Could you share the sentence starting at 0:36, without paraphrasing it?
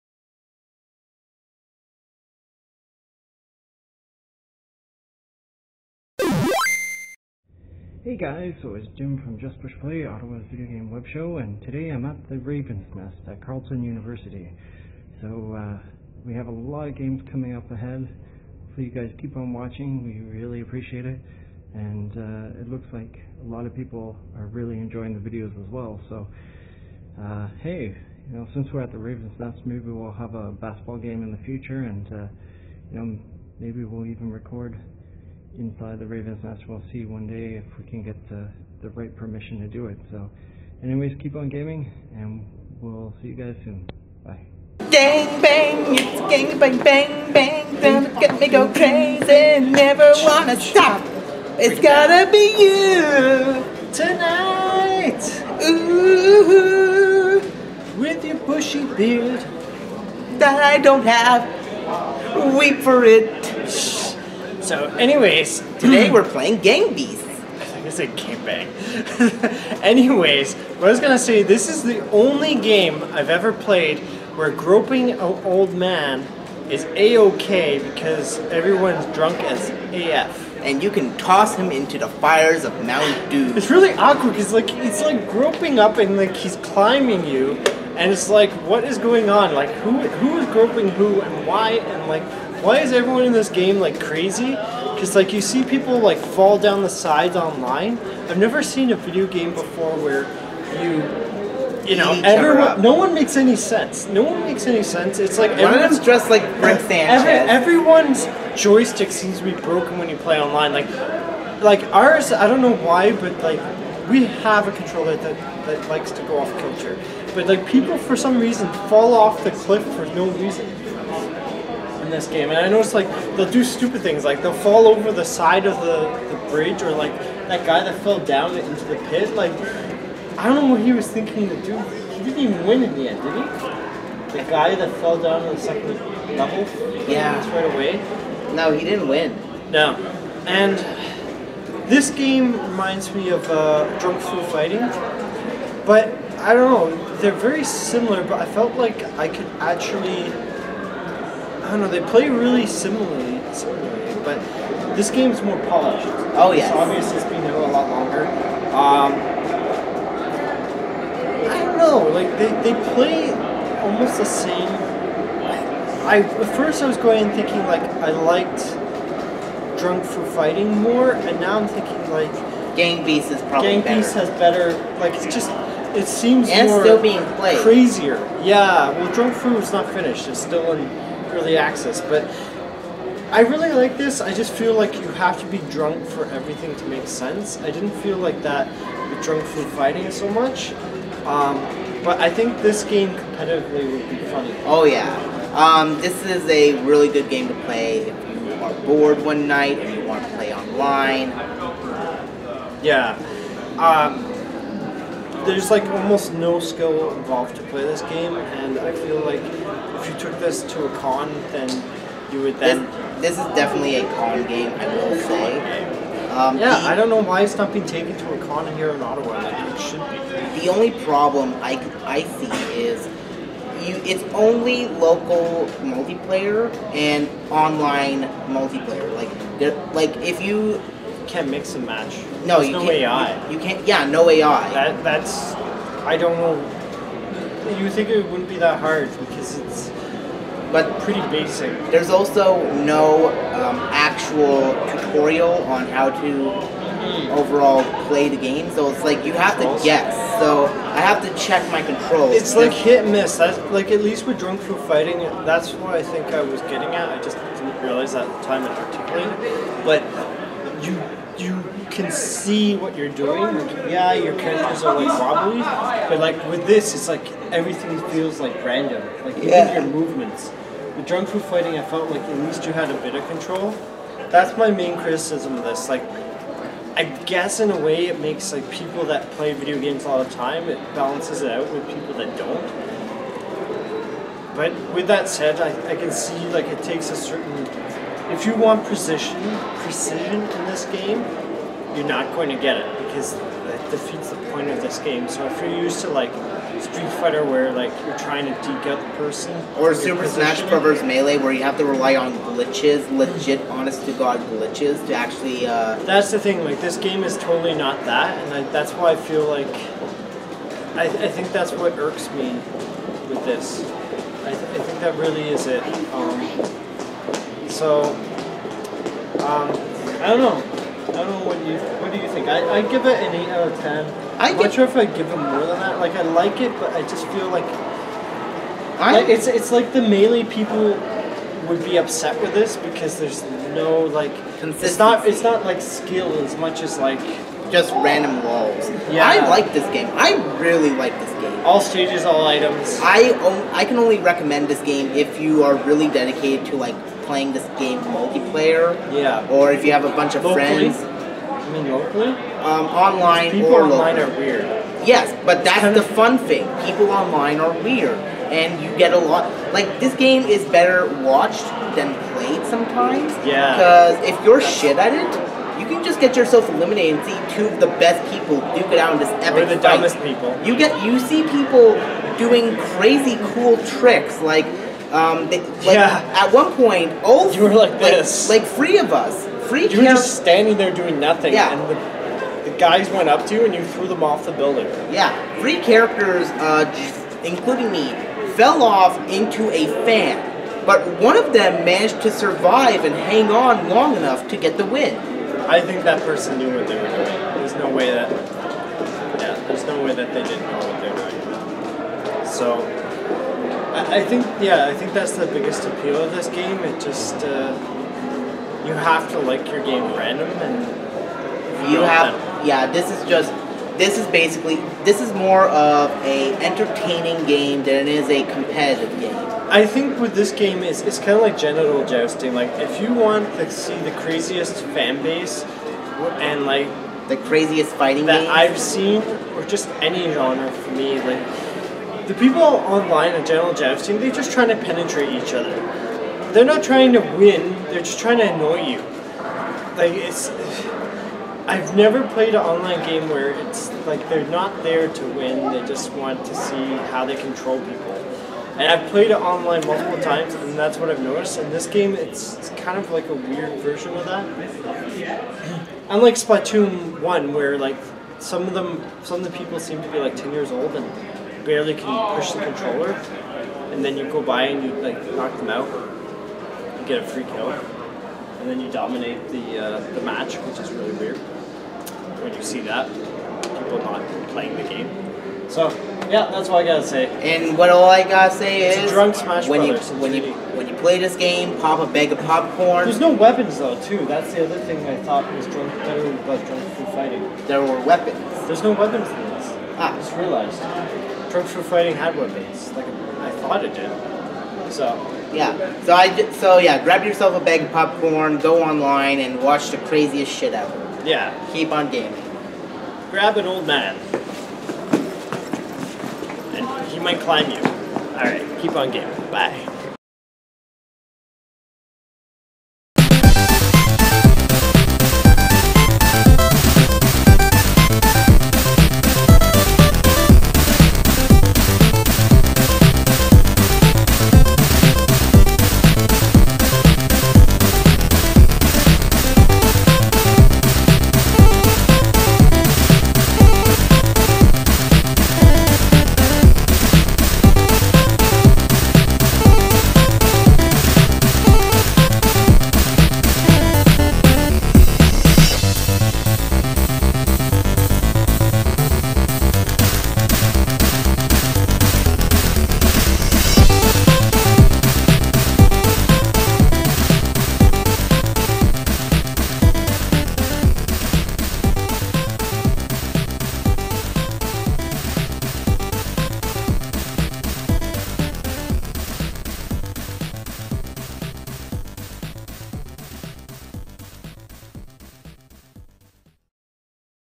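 We'll see one day if we can get the, the right permission to do it.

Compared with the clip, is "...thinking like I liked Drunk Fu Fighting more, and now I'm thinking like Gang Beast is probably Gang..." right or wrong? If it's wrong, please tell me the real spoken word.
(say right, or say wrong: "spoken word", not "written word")
right.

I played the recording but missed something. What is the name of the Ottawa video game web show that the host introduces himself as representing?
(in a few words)
Just Push Play.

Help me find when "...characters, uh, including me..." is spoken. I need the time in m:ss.
6:25.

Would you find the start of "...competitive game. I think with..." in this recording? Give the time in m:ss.
6:58.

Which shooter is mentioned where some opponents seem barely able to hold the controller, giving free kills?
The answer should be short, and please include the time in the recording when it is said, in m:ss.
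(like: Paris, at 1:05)
Splatoon 1, at 7:36.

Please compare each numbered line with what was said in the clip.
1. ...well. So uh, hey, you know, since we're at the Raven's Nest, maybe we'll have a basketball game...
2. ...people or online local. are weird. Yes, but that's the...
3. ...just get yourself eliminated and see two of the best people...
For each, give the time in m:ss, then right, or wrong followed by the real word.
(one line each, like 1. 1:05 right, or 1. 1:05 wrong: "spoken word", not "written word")
1. 0:25 right
2. 5:53 right
3. 6:06 right.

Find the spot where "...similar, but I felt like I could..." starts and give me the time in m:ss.
2:27.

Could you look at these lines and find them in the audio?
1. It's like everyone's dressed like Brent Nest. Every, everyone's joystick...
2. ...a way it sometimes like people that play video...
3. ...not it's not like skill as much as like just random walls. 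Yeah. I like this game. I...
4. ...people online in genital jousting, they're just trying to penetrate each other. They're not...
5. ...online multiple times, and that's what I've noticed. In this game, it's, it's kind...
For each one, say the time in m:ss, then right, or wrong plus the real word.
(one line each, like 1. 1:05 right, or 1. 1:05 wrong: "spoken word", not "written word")
1. 1:45 wrong: "Sanchez", not "Nest"
2. 4:37 wrong: "makes", not "sometimes"
3. 5:34 right
4. 7:12 right
5. 7:29 right.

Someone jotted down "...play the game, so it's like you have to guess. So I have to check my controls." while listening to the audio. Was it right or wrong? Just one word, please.
right.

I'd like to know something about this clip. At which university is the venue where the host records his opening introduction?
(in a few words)
Carleton University.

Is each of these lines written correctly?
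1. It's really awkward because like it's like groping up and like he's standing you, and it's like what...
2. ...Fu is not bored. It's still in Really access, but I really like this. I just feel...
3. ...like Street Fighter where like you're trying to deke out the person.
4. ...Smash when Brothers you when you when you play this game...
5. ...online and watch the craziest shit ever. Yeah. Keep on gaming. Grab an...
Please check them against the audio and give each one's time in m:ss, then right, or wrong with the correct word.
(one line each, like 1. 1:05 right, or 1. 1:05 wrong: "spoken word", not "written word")
1. 1:23 wrong: "climbing", not "standing"
2. 2:59 wrong: "finished", not "bored"
3. 4:56 right
4. 7:59 right
5. 8:18 right.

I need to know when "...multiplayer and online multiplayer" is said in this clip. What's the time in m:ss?
3:45.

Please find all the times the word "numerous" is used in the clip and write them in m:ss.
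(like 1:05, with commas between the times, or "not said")
not said.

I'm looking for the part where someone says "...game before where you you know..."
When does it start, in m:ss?
1:39.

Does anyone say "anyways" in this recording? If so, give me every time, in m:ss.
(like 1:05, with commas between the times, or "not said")
0:40, 1:04, 1:09.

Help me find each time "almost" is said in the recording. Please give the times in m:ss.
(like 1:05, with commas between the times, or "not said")
2:43, 3:25.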